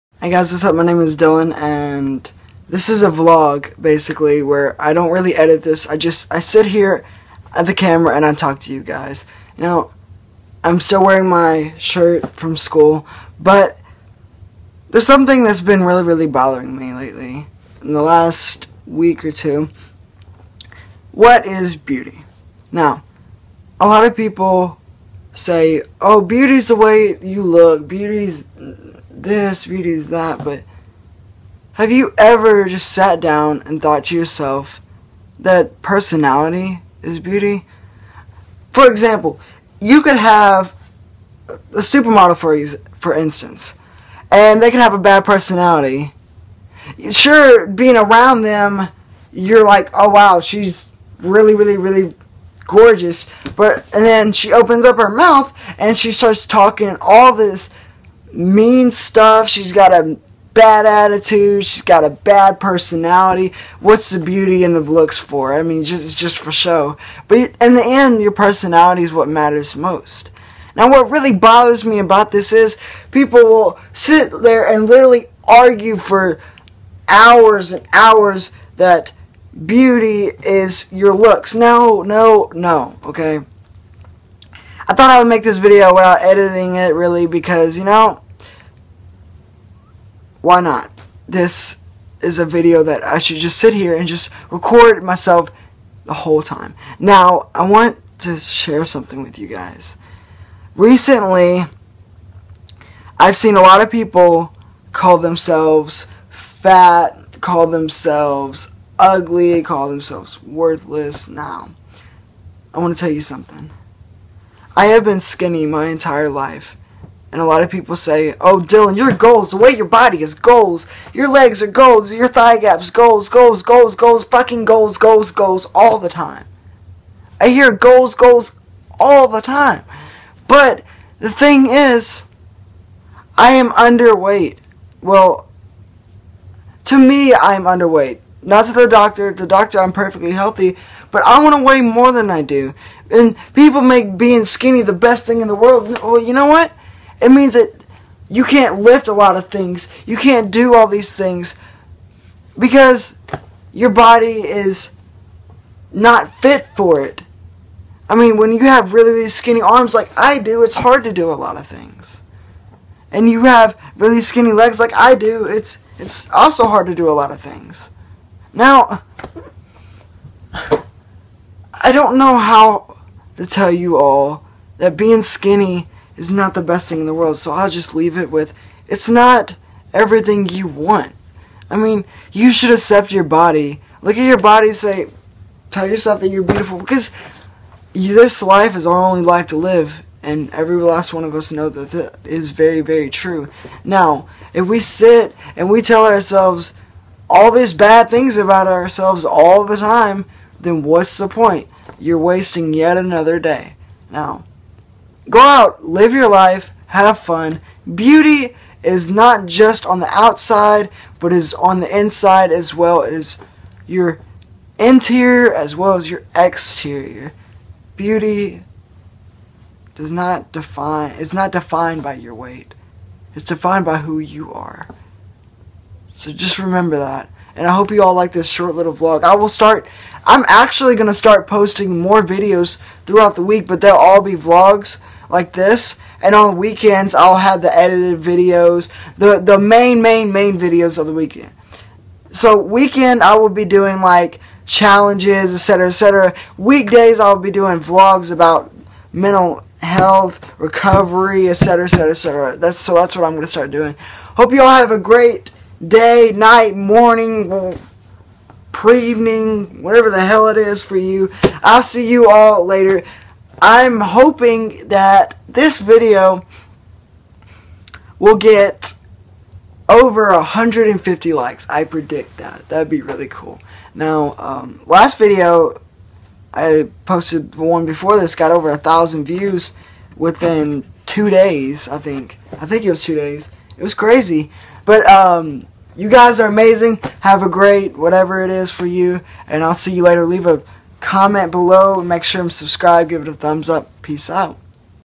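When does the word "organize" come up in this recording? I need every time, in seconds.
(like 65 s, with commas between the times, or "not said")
not said.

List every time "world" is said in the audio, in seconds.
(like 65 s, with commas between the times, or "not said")
145 s, 177 s.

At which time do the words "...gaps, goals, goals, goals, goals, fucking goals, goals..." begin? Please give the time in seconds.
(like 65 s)
122 s.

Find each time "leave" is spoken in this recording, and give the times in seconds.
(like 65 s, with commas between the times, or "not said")
177 s, 290 s.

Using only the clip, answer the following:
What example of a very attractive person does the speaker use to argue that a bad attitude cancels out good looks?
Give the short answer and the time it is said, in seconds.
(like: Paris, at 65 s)
a supermodel, at 41 s.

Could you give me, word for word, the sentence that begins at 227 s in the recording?
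And I hope you all like this short little vlog.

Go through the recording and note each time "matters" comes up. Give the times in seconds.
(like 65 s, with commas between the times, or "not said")
69 s.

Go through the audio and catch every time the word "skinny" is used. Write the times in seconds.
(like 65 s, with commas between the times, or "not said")
115 s, 144 s, 159 s, 164 s, 175 s.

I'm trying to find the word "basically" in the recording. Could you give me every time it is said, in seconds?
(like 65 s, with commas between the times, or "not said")
3 s.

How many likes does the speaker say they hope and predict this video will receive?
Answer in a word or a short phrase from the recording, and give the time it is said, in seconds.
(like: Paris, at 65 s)
over 150, at 269 s.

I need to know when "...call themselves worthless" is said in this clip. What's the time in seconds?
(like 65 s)
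109 s.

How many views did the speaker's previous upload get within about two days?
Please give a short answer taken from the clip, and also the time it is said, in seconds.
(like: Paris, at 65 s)
over 1000, at 278 s.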